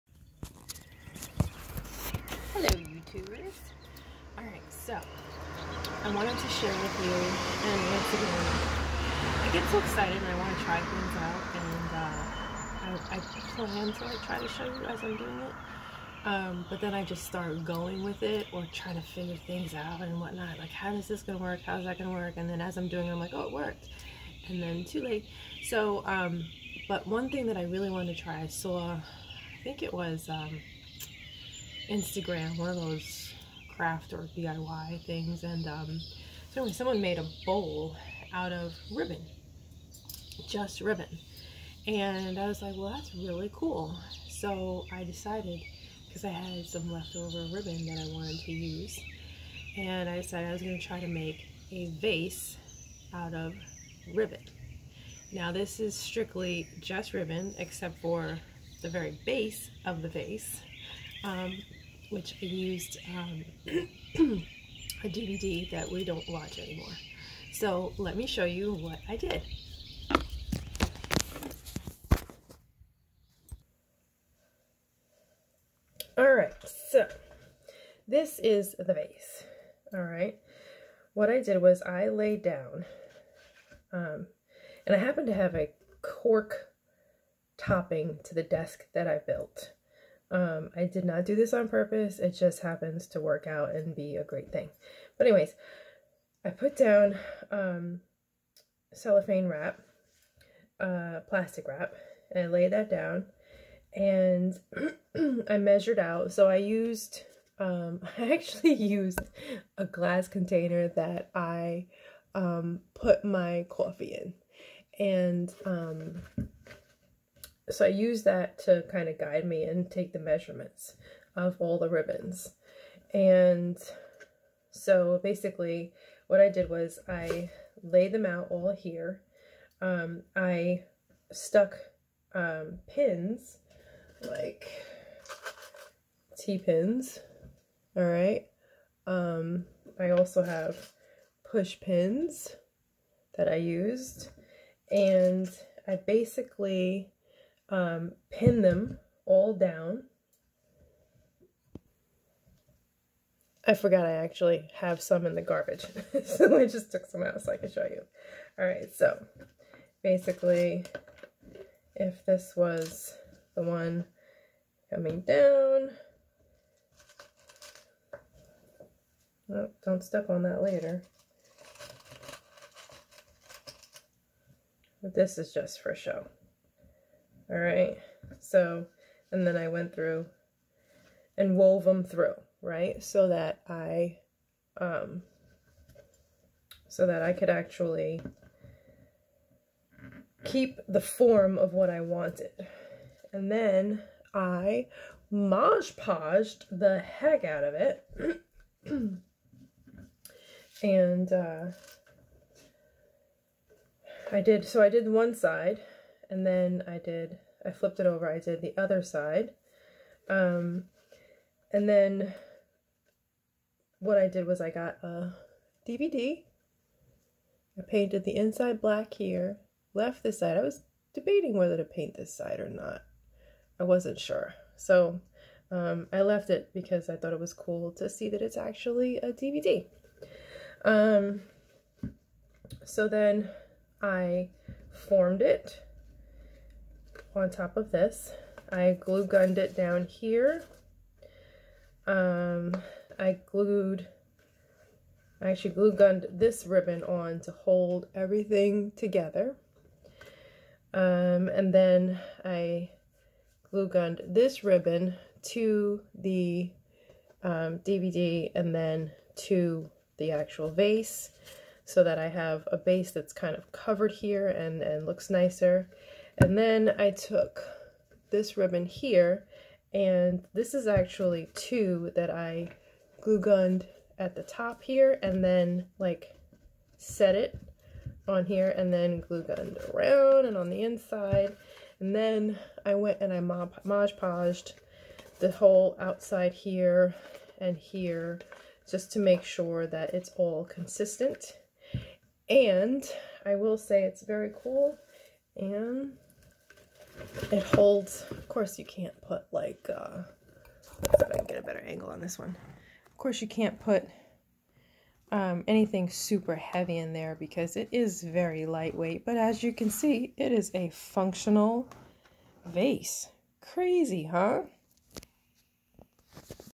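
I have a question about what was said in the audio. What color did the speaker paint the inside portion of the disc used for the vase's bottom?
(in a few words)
Black.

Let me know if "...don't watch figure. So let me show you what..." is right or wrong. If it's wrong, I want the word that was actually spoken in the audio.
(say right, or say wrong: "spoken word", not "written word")
wrong: "anymore", not "figure".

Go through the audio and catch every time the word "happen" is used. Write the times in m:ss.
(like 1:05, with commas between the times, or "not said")
1:24, 1:32.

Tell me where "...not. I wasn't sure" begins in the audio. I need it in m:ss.
3:42.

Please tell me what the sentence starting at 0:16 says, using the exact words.
Um, but then I just start going with it or trying to figure things out and whatnot.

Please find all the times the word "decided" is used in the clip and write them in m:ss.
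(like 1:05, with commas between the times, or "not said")
0:45, 0:50.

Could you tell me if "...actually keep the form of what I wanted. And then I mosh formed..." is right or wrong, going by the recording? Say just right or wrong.
wrong.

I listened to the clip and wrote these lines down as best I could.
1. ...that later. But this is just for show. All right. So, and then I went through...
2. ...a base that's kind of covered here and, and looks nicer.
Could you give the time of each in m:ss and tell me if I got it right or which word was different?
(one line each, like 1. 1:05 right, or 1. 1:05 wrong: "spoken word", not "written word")
1. 2:50 right
2. 4:22 right.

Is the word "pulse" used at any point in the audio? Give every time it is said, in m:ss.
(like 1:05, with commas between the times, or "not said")
not said.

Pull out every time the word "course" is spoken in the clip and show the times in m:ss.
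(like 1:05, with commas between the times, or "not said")
4:58, 5:03.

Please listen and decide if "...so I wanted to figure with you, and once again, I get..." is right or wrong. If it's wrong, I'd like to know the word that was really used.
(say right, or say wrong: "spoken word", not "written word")
wrong: "share", not "figure".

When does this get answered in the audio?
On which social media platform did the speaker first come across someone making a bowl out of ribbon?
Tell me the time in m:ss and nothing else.
0:31.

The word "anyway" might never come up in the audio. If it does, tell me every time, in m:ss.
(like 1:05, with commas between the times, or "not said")
0:36, 1:35.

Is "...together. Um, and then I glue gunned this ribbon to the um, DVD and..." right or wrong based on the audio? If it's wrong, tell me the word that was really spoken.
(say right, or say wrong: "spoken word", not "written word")
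right.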